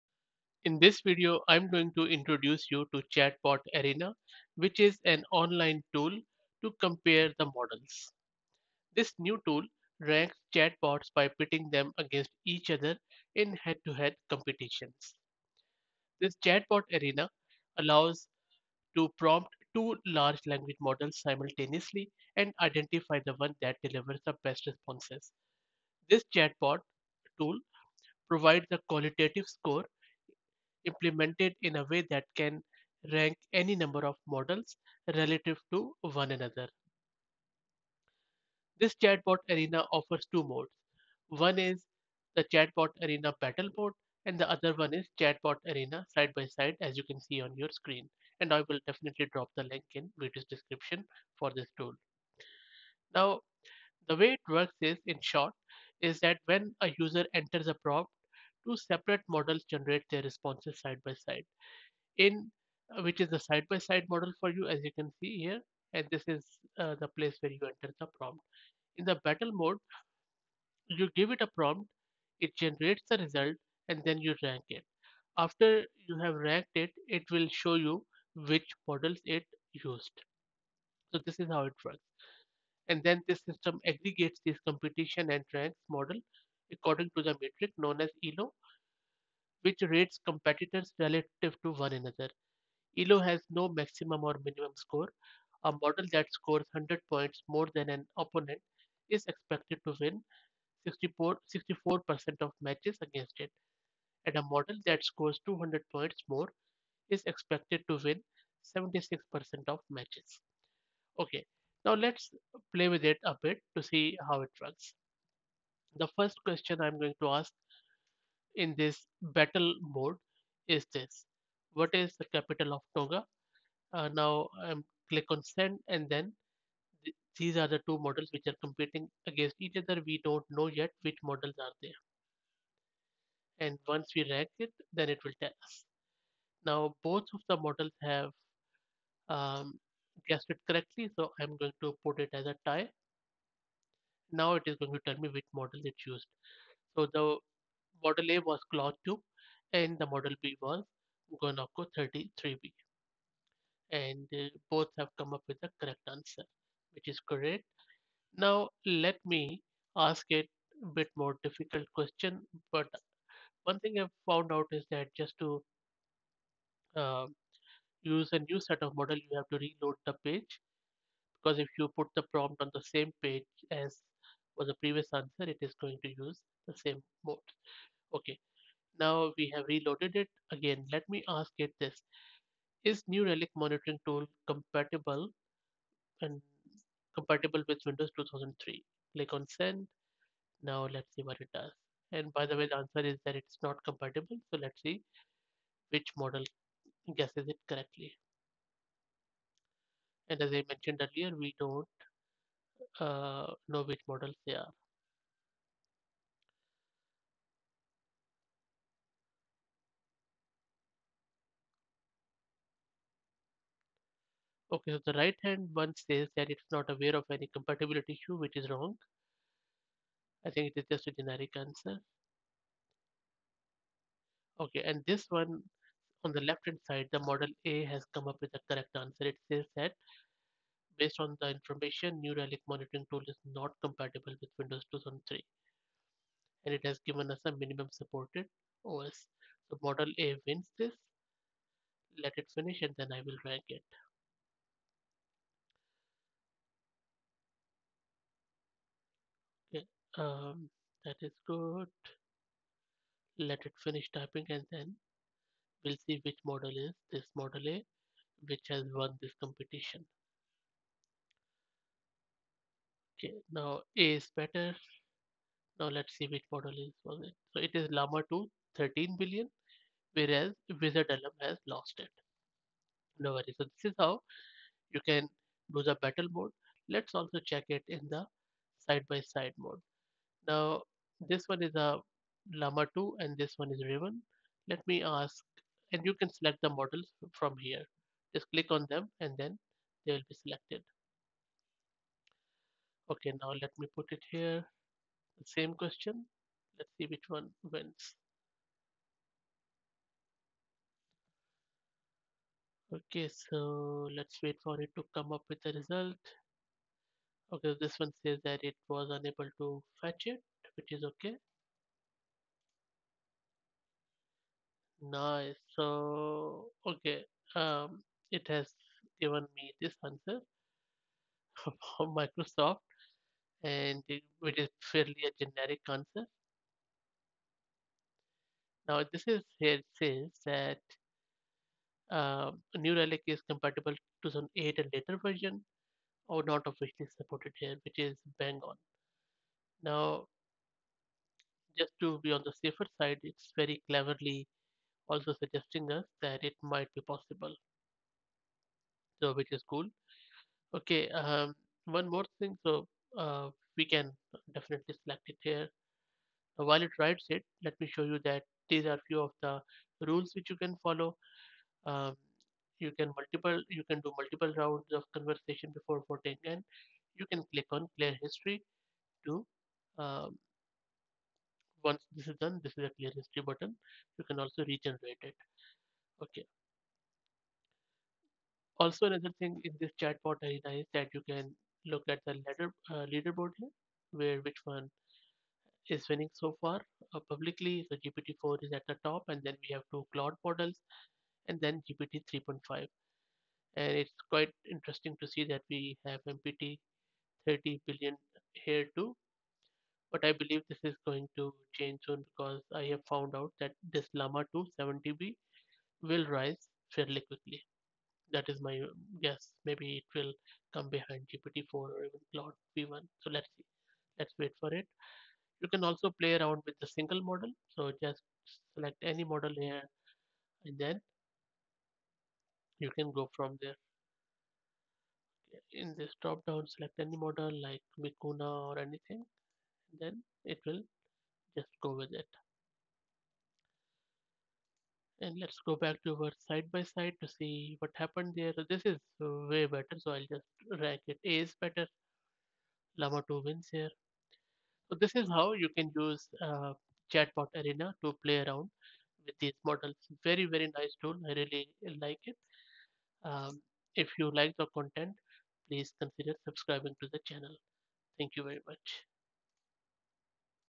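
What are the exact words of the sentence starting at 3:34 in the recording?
Okay, so the right hand one says that it's not aware of any compatibility issue, which is wrong.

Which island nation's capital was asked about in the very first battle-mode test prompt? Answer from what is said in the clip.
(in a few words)
Tonga.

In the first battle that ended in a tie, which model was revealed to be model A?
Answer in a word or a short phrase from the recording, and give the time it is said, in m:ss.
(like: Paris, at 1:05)
Claude 2, at 2:28.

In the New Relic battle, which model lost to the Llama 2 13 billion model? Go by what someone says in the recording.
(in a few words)
WizardLM.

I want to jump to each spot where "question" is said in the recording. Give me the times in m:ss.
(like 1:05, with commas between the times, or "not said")
1:56, 2:41, 4:55.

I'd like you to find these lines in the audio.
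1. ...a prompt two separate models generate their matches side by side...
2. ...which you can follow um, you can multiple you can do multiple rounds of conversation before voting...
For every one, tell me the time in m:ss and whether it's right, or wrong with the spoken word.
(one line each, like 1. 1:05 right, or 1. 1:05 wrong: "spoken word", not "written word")
1. 0:57 wrong: "responses", not "matches"
2. 6:00 right.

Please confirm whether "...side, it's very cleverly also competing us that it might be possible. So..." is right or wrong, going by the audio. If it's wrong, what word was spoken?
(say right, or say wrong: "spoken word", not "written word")
wrong: "suggesting", not "competing".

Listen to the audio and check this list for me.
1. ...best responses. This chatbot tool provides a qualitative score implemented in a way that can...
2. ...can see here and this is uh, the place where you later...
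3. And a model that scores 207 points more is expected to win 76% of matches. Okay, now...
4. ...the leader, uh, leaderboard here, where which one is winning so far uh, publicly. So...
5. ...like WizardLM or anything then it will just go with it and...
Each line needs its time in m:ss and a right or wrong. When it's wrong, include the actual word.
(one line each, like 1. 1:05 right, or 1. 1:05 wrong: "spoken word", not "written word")
1. 0:24 right
2. 1:04 wrong: "enter", not "later"
3. 1:44 wrong: "200", not "207"
4. 6:22 right
5. 7:07 wrong: "Vicuna", not "WizardLM".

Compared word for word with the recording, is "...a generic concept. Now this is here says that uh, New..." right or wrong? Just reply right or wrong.
right.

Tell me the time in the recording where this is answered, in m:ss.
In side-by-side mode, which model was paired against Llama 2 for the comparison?
4:43.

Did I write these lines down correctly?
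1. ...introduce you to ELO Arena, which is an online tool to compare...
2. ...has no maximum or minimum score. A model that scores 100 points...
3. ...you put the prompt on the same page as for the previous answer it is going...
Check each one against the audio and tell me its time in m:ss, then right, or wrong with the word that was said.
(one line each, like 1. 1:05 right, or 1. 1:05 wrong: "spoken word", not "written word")
1. 0:02 wrong: "Chatbot", not "ELO"
2. 1:33 right
3. 2:51 right.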